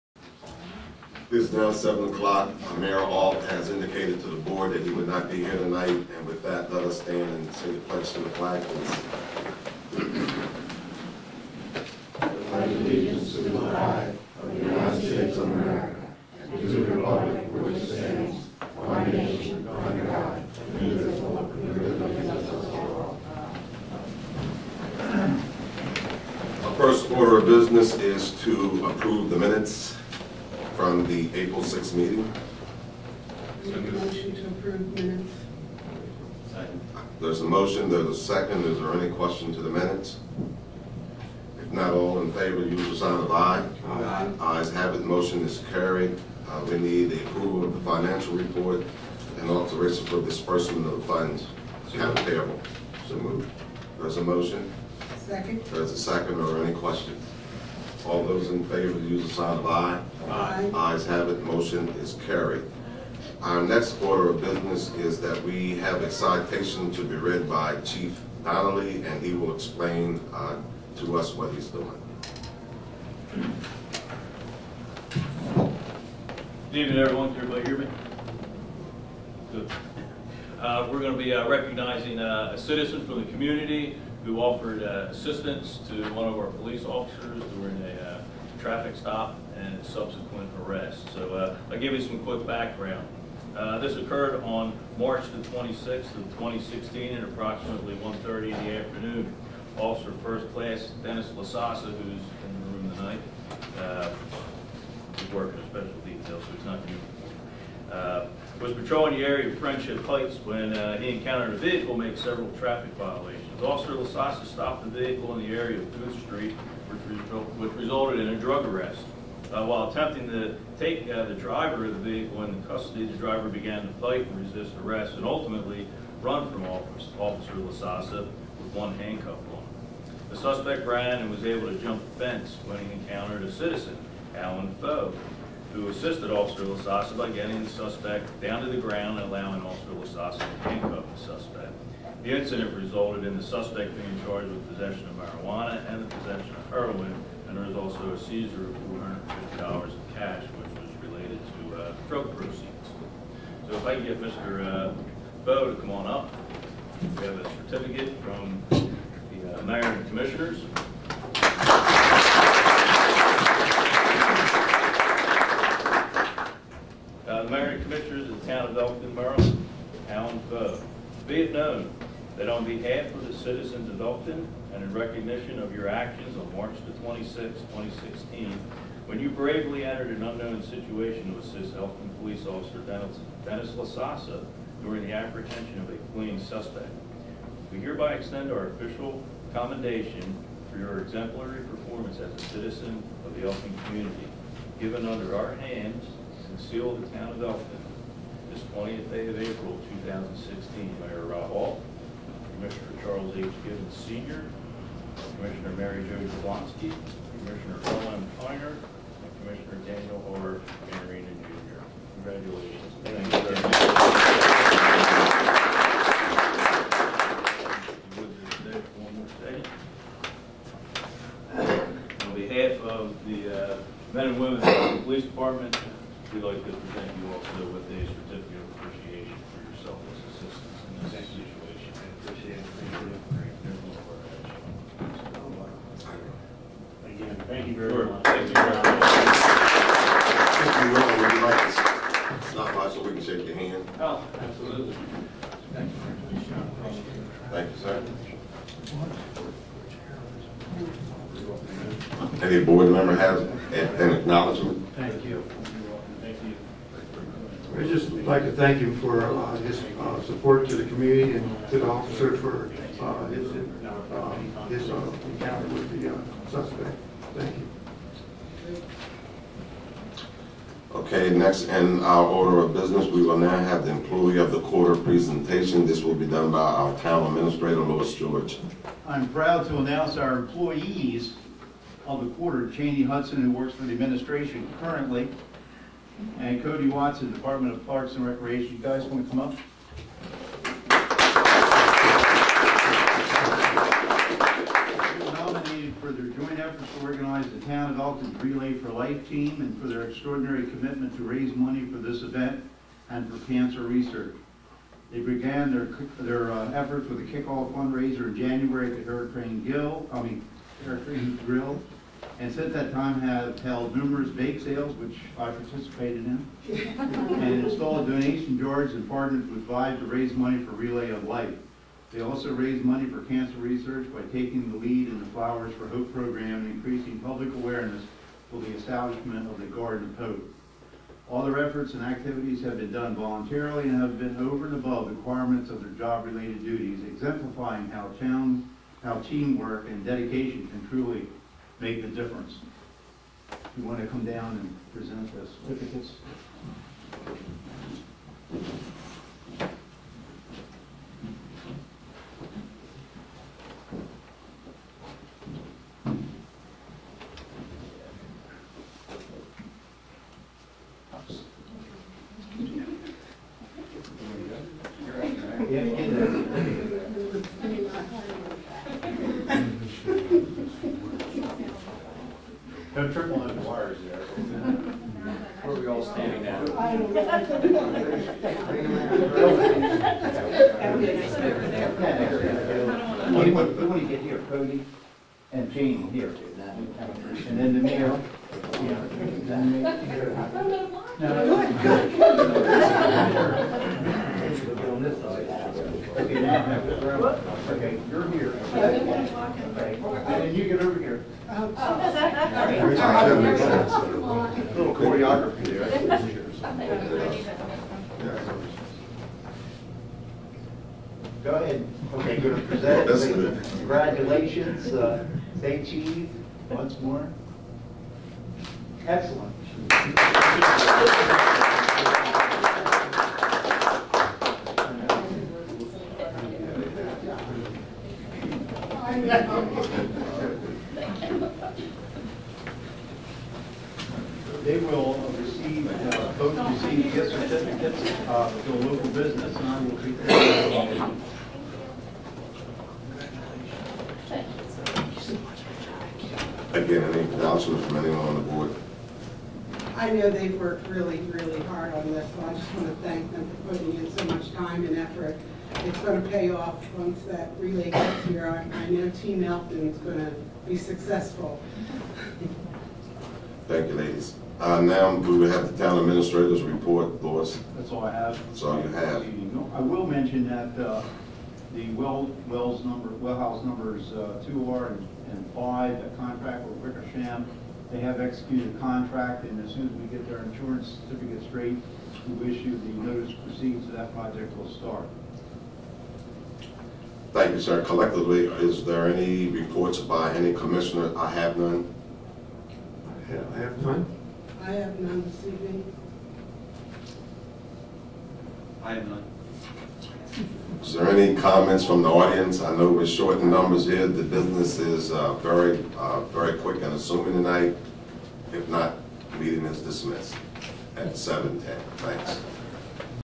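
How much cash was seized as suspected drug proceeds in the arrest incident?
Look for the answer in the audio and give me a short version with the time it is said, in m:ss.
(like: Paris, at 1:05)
$450, at 2:29.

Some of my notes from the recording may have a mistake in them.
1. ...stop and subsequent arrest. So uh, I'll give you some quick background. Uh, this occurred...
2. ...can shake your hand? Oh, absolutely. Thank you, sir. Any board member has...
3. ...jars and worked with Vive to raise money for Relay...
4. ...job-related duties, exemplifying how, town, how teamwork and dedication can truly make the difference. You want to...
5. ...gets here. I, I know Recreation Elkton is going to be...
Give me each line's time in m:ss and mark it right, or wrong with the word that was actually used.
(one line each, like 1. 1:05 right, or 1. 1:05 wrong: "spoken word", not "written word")
1. 1:28 right
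2. 4:03 right
3. 5:18 wrong: "partnered", not "worked"
4. 5:35 right
5. 7:37 wrong: "Team", not "Recreation".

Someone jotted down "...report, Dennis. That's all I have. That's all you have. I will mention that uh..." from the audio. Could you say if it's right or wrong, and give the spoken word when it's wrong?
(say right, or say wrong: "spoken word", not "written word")
wrong: "Louis", not "Dennis".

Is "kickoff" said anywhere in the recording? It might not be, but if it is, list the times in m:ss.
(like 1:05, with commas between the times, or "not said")
5:07.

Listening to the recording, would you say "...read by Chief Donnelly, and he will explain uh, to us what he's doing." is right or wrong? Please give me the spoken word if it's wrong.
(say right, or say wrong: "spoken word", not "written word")
right.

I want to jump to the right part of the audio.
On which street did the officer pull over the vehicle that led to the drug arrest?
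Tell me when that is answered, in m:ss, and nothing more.
1:56.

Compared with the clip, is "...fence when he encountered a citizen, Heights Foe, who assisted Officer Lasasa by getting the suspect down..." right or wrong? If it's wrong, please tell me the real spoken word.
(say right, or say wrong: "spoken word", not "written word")
wrong: "Alan", not "Heights".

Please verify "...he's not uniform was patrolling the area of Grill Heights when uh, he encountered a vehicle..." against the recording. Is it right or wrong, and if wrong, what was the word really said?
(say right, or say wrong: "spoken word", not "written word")
wrong: "Friendship", not "Grill".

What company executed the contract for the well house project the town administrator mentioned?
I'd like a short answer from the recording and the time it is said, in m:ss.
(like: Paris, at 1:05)
Wickersham, at 7:56.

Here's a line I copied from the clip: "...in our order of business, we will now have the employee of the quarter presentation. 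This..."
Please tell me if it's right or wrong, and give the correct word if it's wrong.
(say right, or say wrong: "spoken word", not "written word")
right.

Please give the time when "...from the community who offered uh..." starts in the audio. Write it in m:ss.
1:23.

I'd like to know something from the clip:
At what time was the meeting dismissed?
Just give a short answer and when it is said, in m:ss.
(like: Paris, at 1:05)
7:10, at 8:31.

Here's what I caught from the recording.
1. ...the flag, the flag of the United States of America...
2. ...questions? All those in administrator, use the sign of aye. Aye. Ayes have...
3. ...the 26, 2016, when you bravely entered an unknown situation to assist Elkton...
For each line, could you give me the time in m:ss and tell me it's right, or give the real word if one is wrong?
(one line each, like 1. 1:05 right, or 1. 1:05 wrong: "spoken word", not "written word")
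1. 0:08 right
2. 0:56 wrong: "favor", not "administrator"
3. 2:56 right.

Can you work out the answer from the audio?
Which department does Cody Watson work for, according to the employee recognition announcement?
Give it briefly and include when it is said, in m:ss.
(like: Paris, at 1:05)
Parks and Recreation, at 4:47.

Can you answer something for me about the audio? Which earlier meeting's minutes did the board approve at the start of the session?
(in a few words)
April 6th.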